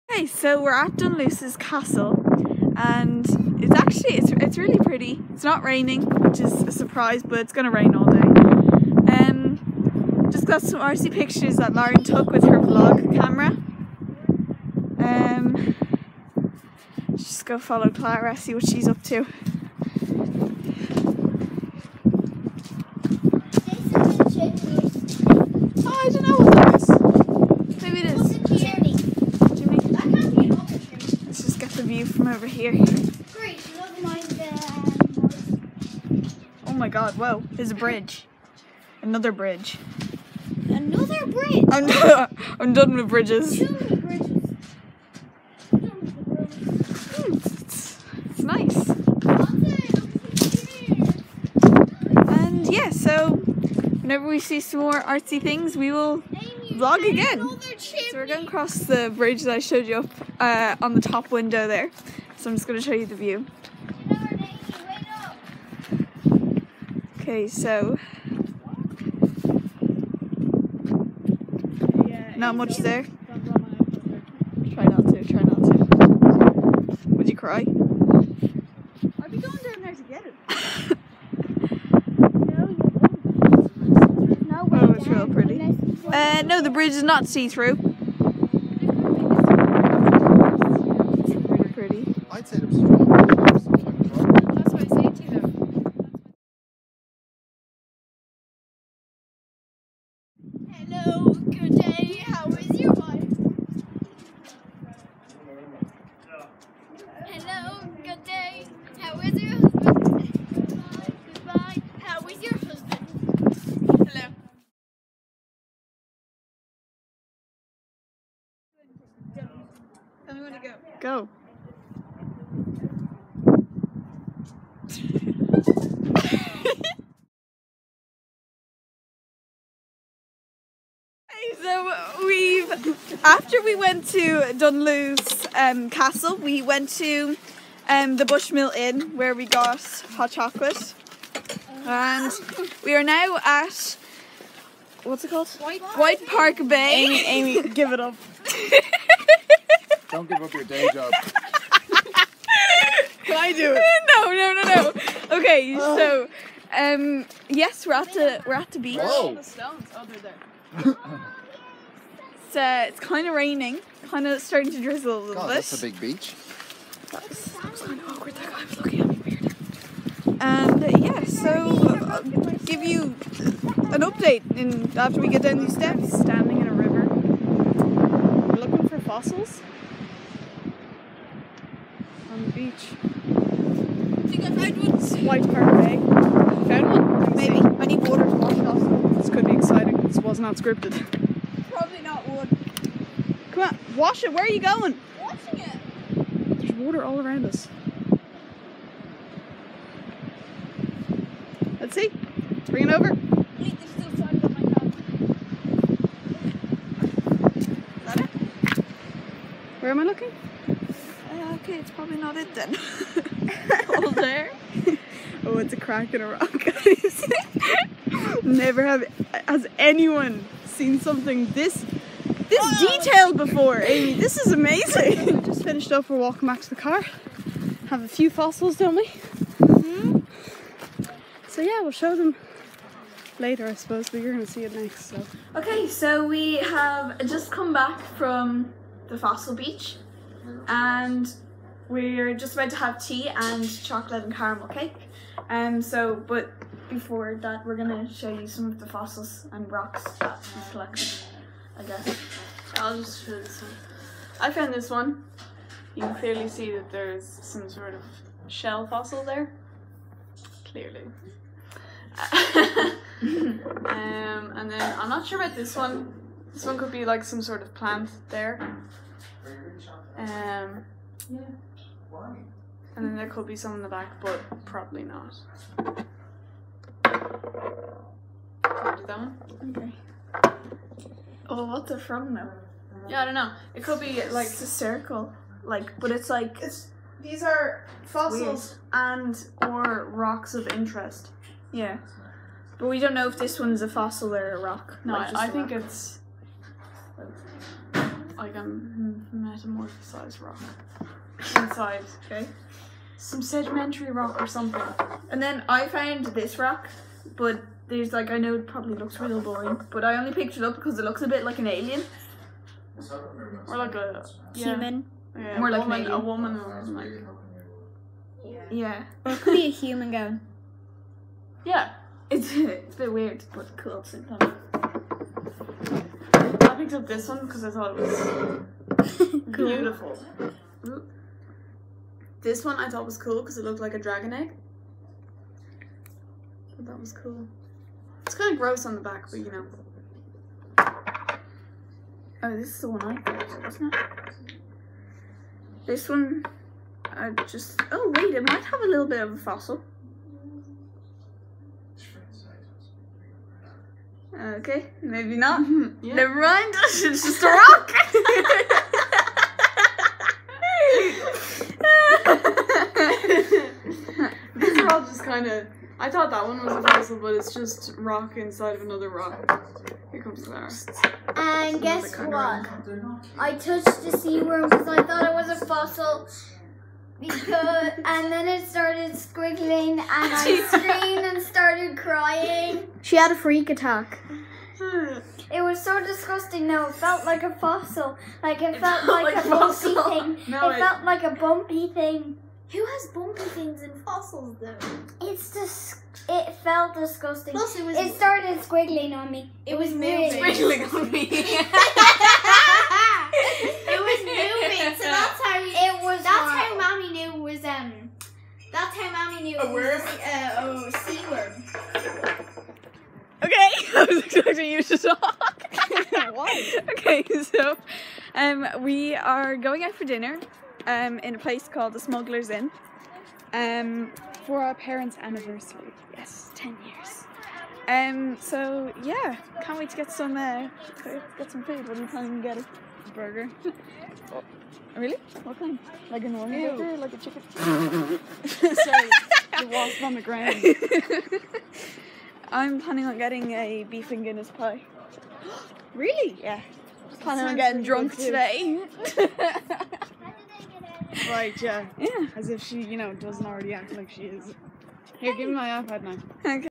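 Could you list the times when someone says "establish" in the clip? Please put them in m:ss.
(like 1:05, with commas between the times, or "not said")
not said.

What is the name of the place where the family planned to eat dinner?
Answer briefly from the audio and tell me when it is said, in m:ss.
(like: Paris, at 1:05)
Smuggler's Inn, at 7:01.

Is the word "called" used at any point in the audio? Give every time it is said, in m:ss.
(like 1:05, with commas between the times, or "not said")
2:25, 7:01.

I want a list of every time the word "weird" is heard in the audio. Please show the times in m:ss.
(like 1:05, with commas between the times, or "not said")
2:49, 5:23.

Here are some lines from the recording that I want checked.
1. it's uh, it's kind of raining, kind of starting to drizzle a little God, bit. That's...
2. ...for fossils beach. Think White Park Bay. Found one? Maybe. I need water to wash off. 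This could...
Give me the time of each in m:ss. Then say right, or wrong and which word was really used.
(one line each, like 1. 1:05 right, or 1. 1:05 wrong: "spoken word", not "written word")
1. 2:42 right
2. 2:58 right.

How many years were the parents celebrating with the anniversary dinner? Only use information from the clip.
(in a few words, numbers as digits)
10.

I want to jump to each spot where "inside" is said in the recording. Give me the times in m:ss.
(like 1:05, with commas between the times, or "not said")
5:01, 6:08.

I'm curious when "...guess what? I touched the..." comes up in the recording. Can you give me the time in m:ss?
6:11.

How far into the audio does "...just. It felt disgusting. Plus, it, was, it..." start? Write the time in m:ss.
6:35.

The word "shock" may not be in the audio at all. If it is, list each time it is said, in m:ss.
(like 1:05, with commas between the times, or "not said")
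not said.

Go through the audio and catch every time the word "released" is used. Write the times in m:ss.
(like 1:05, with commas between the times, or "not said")
not said.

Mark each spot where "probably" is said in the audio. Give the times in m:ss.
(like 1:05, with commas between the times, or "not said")
3:11, 3:31, 4:34, 5:08.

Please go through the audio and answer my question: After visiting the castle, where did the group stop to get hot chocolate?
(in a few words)
Bushmill Inn.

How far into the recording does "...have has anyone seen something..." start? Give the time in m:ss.
3:38.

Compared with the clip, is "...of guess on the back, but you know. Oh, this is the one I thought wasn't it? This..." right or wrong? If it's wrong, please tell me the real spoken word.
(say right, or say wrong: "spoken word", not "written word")
wrong: "gross", not "guess".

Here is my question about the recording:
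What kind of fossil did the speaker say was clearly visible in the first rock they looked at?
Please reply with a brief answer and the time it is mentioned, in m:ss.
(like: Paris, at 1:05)
Shell, at 4:18.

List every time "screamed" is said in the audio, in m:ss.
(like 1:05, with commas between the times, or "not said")
6:20.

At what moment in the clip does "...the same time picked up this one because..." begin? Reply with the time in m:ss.
5:24.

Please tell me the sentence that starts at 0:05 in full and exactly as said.
It's not raining, which is a surprise, but it's gonna rain all day.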